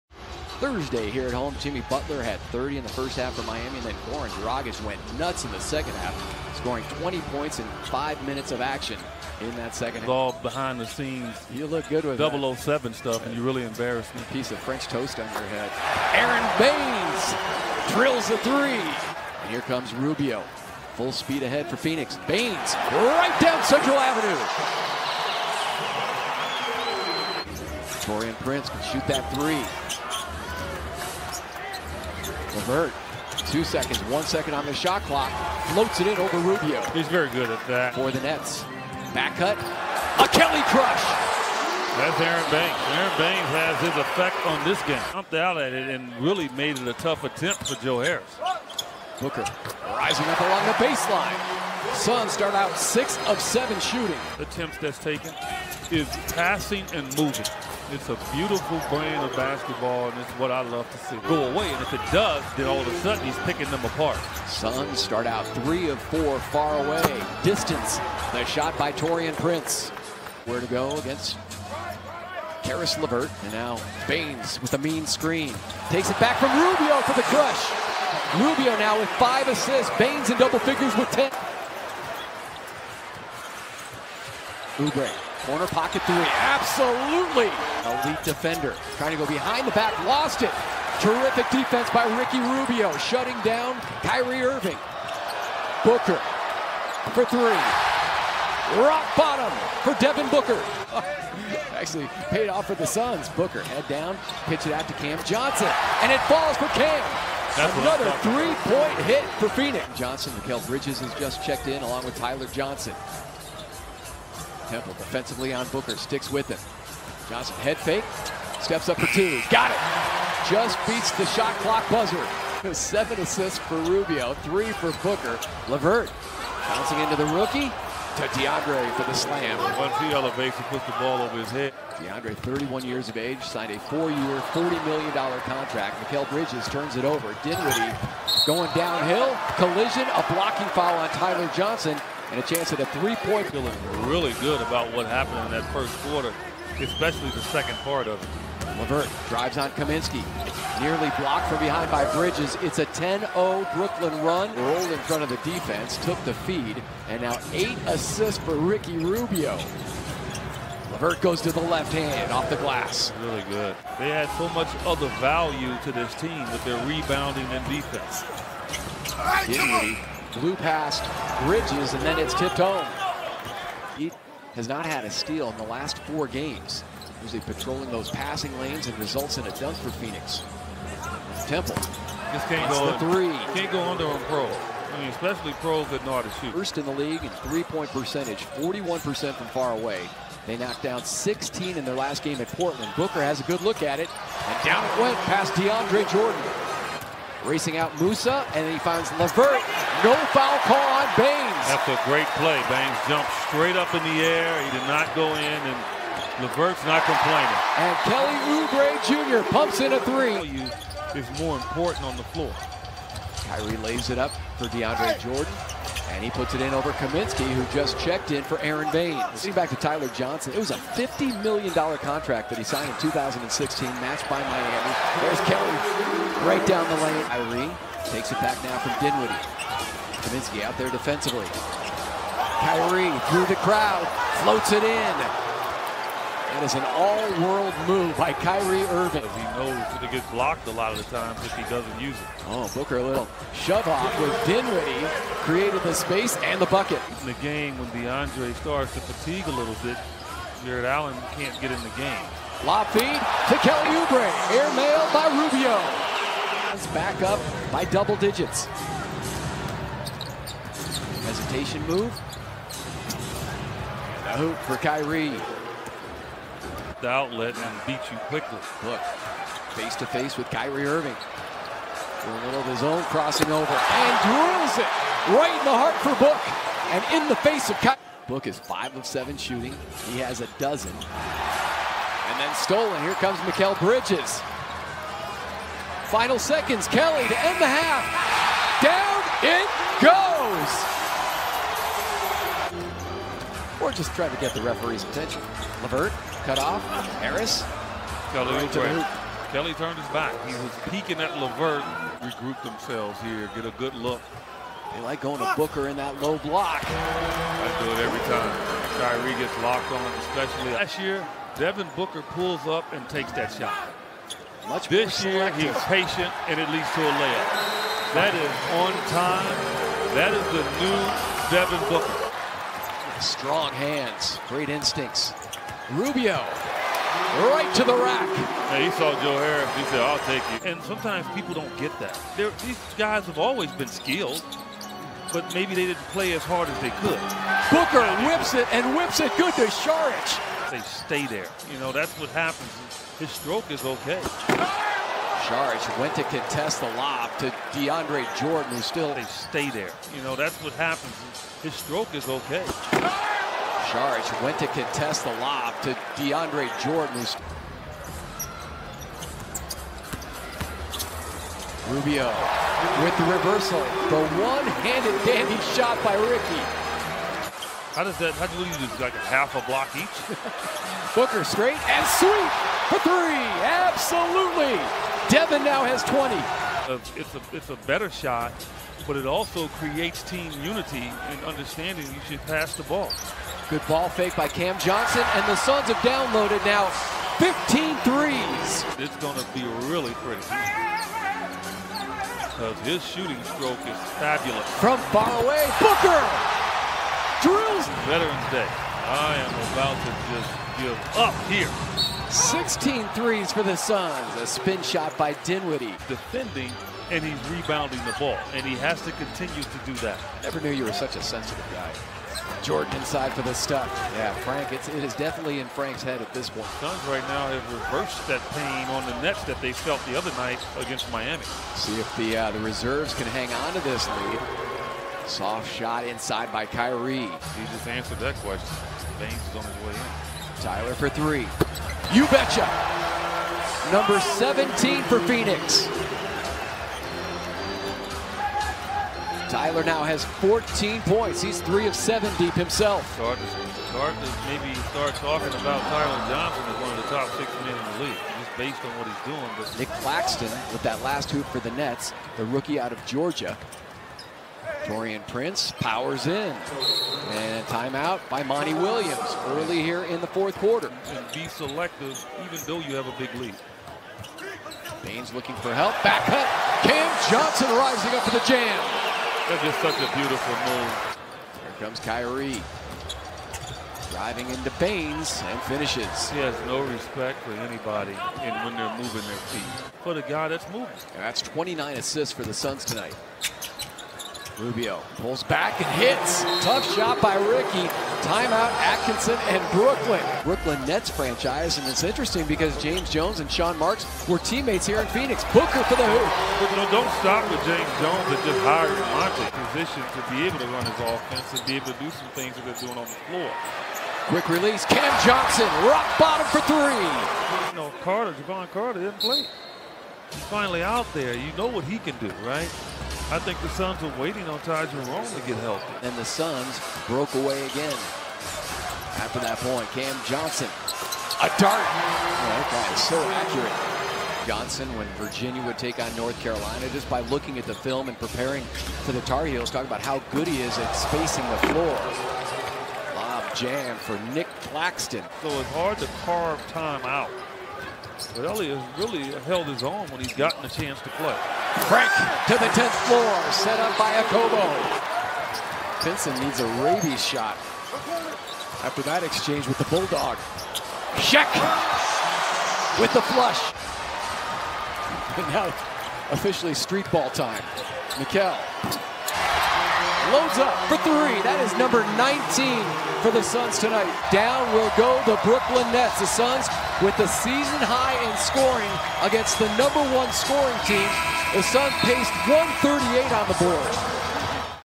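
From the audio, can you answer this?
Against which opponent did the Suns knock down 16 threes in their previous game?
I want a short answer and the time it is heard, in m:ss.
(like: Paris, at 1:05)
Portland, at 3:12.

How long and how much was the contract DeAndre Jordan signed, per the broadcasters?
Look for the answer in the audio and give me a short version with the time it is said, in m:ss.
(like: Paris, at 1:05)
four-year, $40 million, at 2:13.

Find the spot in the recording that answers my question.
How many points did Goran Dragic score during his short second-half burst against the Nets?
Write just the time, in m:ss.
0:07.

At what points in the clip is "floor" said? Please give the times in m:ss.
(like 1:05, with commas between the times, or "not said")
3:32, 8:23, 8:51, 9:03.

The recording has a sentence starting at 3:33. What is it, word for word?
Kyrie lays it up for DeAndre Jordan.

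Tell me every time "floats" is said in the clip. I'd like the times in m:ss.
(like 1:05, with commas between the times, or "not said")
0:35, 3:54.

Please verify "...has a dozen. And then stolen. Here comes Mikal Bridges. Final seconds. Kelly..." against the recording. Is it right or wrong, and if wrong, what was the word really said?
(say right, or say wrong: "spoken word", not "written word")
right.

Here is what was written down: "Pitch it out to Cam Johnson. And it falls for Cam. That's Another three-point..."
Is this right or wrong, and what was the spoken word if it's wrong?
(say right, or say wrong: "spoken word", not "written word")
right.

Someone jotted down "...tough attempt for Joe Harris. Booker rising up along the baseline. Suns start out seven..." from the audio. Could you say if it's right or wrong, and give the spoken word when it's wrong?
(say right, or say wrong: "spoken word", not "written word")
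wrong: "six", not "seven".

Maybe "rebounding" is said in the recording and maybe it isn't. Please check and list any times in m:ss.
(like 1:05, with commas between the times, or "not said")
2:46, 6:47.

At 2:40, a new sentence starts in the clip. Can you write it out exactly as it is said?
Levert goes to the left hand off the glass.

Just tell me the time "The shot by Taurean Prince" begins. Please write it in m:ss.
1:08.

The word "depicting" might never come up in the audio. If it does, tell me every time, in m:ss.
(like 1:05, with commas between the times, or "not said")
not said.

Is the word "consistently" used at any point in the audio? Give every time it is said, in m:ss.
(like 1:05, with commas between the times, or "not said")
not said.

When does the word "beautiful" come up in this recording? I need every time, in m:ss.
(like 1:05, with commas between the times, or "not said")
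0:58, 7:50.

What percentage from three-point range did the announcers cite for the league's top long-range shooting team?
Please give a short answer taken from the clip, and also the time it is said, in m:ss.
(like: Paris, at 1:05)
41%, at 3:08.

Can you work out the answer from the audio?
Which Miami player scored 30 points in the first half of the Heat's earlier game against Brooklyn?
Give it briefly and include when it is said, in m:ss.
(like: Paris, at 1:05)
Jimmy Butler, at 0:01.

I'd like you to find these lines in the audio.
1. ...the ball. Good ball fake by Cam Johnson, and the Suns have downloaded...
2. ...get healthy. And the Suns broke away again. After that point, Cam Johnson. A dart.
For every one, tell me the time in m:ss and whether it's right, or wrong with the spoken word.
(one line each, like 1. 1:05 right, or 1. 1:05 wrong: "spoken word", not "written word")
1. 6:22 right
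2. 8:35 right.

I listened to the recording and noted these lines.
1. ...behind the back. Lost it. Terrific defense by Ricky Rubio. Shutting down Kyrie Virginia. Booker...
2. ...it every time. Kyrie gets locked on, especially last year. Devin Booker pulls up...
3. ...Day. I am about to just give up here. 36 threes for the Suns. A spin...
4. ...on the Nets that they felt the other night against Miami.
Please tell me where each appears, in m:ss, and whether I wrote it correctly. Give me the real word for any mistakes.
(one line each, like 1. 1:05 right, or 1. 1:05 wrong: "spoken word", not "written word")
1. 1:29 wrong: "Irving", not "Virginia"
2. 5:07 right
3. 6:38 wrong: "16", not "36"
4. 6:58 right.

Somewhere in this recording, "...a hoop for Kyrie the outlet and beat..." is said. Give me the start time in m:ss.
4:24.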